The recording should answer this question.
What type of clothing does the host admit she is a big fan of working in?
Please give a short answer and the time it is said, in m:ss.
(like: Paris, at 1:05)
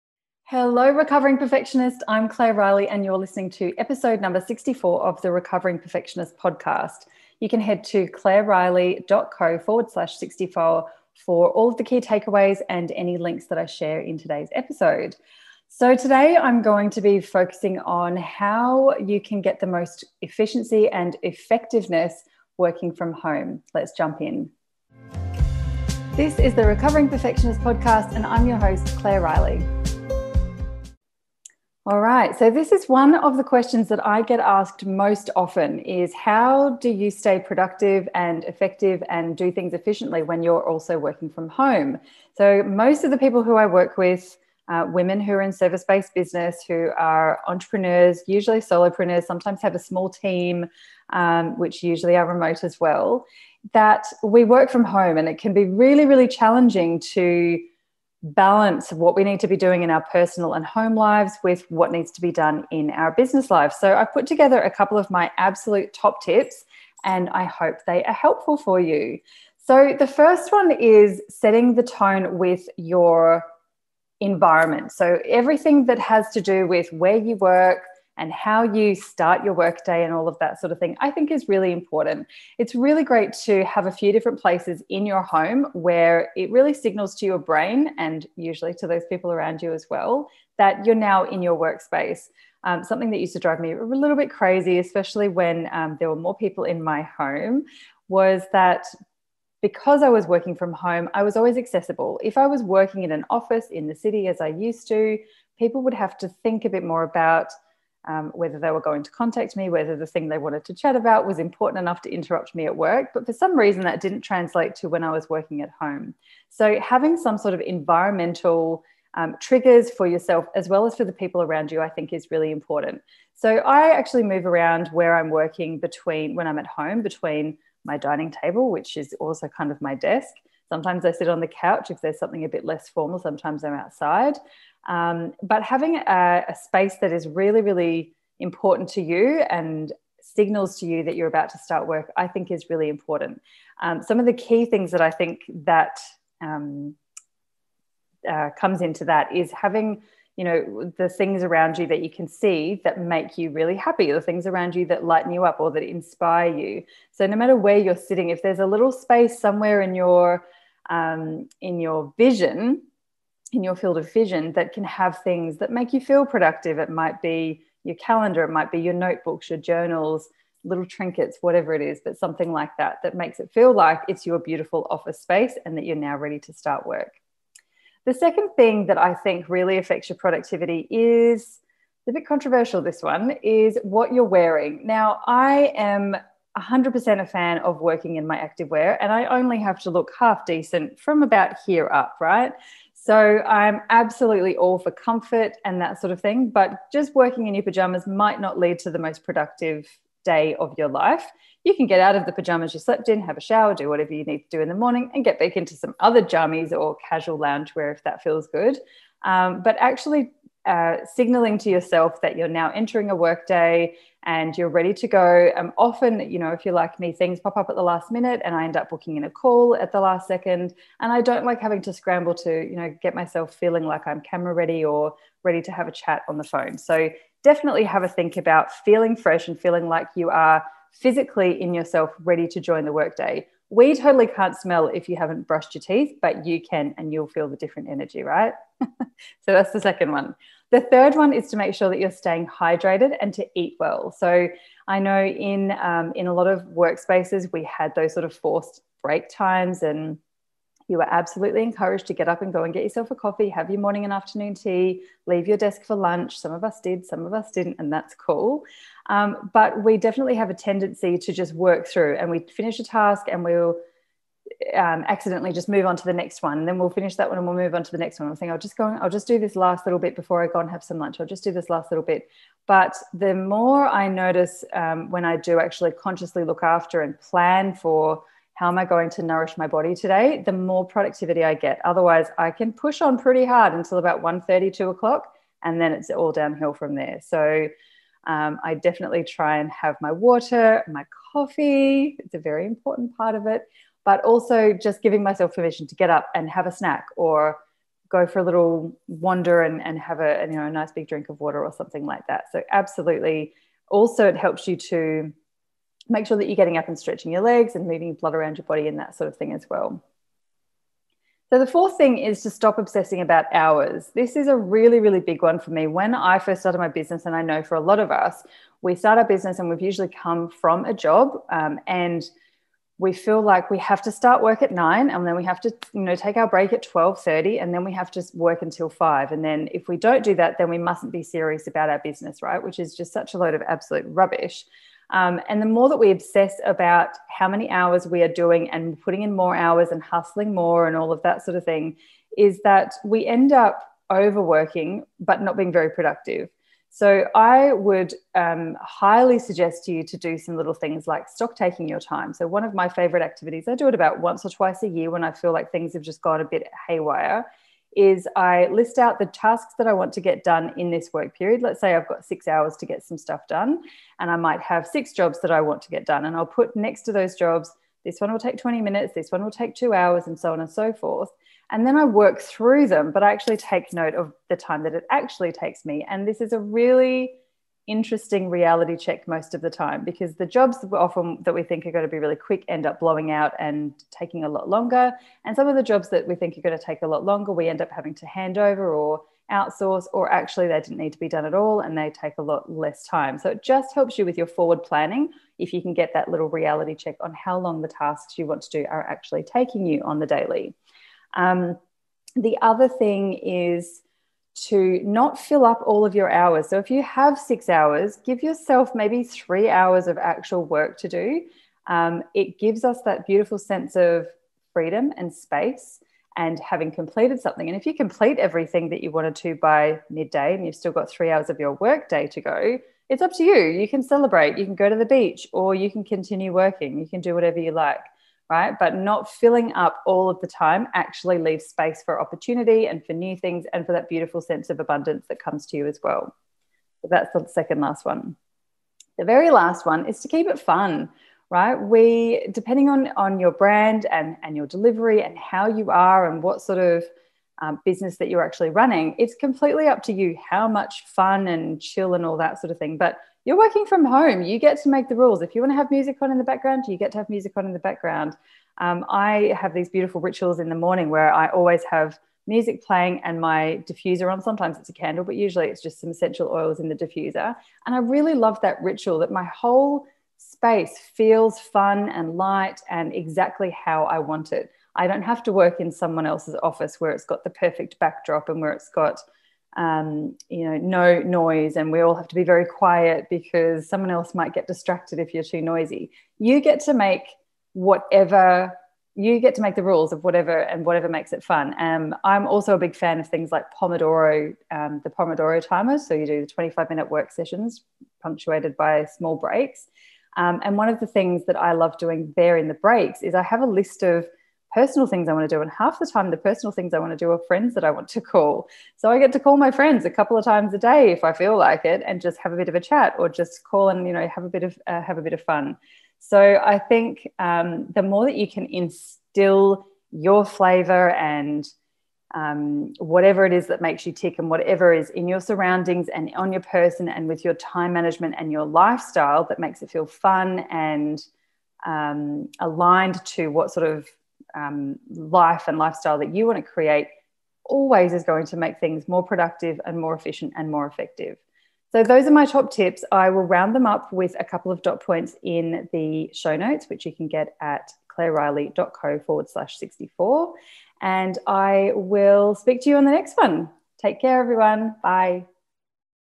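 activewear, at 3:08.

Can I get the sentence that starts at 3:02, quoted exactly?
This one is what you're wearing.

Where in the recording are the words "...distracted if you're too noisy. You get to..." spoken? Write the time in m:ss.
8:04.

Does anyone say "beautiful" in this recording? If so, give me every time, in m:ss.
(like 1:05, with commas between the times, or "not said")
2:54, 6:53, 7:14, 7:39.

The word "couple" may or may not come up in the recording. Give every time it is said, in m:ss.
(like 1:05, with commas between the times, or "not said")
1:04, 8:30, 9:04.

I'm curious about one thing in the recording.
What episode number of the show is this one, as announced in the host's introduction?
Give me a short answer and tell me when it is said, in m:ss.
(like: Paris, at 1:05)
64, at 0:03.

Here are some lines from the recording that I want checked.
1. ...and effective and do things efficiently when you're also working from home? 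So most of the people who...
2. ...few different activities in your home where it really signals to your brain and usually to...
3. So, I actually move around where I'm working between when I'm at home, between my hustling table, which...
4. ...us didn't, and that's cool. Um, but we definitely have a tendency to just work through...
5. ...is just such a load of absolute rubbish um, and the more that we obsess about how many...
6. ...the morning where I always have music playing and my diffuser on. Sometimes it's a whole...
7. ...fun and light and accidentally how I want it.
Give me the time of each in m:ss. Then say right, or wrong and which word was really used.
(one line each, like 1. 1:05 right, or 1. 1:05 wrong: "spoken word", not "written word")
1. 0:38 right
2. 1:23 wrong: "places", not "activities"
3. 2:03 wrong: "dining", not "hustling"
4. 4:17 right
5. 5:32 right
6. 7:40 wrong: "candle", not "whole"
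7. 7:51 wrong: "exactly", not "accidentally".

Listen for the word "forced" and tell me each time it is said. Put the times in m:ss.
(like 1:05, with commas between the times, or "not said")
4:08.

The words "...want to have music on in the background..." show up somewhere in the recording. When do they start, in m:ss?
7:35.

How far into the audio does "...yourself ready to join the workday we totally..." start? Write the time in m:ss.
3:51.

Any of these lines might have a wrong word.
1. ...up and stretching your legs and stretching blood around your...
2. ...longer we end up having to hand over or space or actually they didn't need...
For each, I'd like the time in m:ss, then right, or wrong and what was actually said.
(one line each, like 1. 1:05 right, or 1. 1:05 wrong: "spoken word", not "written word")
1. 5:06 wrong: "moving", not "stretching"
2. 6:27 wrong: "outsource", not "space".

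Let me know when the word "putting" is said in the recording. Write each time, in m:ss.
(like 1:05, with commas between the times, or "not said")
5:38.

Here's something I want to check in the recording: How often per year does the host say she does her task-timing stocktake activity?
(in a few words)
once or twice.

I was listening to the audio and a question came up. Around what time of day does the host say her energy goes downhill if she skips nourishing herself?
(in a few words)
1.30.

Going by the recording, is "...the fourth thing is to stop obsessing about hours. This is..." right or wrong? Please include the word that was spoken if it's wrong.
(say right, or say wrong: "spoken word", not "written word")
right.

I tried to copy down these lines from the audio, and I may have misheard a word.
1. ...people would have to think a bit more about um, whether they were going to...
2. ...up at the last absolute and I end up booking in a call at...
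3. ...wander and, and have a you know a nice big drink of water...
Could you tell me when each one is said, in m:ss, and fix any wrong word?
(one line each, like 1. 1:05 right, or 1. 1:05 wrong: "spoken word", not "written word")
1. 1:45 right
2. 3:37 wrong: "minute", not "absolute"
3. 4:59 right.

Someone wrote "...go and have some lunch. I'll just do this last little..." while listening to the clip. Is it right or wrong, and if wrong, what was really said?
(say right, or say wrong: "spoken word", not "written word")
right.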